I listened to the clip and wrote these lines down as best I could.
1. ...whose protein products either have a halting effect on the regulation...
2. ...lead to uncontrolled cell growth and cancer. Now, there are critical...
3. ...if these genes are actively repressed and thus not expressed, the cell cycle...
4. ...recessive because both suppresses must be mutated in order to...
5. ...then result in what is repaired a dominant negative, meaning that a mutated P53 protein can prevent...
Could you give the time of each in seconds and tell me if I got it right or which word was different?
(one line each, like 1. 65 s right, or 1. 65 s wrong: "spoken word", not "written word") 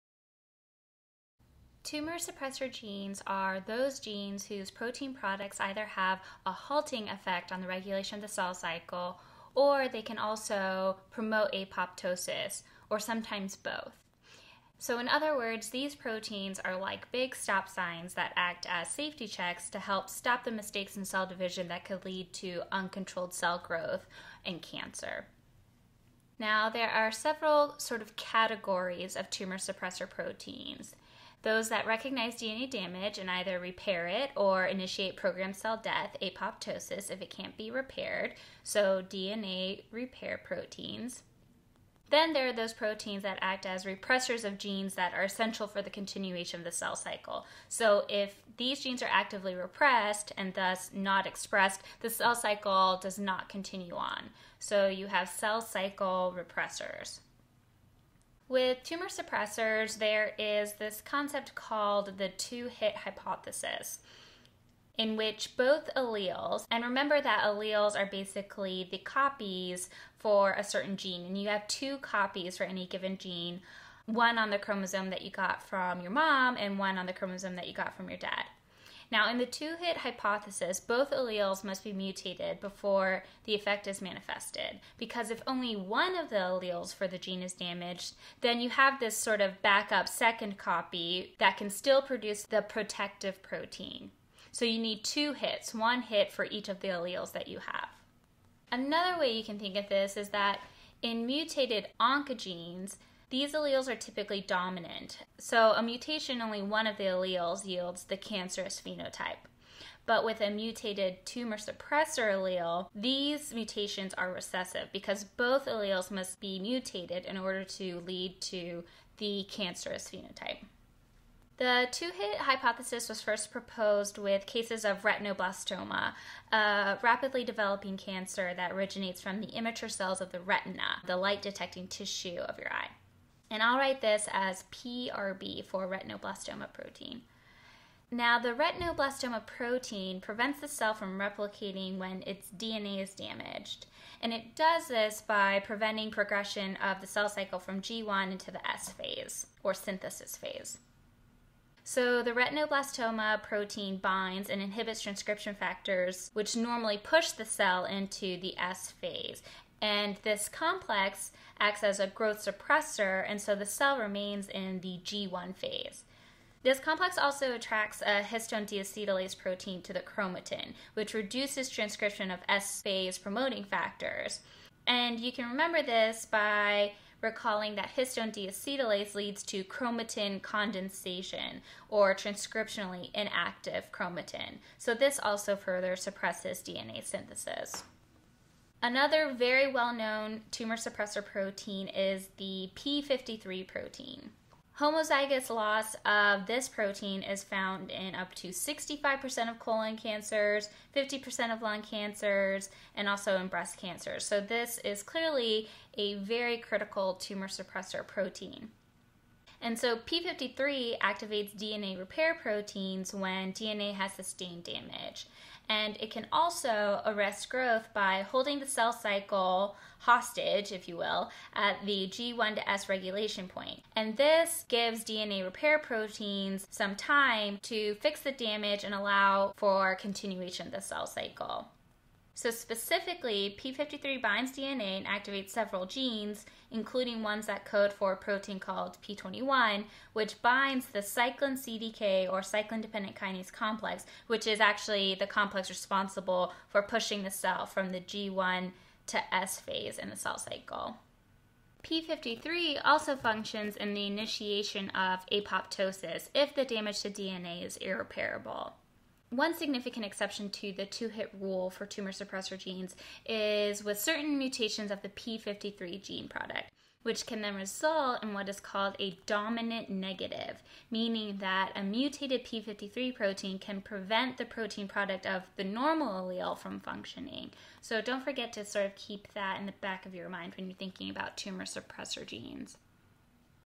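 1. 4 s right
2. 22 s wrong: "several", not "critical"
3. 48 s right
4. 114 s wrong: "alleles", not "suppresses"
5. 267 s wrong: "called", not "repaired".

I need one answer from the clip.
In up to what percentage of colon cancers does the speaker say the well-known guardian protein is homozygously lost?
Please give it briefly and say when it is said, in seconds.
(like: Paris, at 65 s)
65%, at 198 s.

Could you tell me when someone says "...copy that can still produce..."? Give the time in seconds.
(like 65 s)
90 s.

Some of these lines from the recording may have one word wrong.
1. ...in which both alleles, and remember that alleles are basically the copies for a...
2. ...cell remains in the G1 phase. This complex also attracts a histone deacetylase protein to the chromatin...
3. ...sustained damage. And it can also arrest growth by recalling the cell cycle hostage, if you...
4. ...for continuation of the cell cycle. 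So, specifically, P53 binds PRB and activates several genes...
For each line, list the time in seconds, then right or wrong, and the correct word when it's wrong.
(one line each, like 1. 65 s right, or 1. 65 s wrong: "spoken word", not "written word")
1. 64 s right
2. 163 s right
3. 214 s wrong: "holding", not "recalling"
4. 229 s wrong: "DNA", not "PRB".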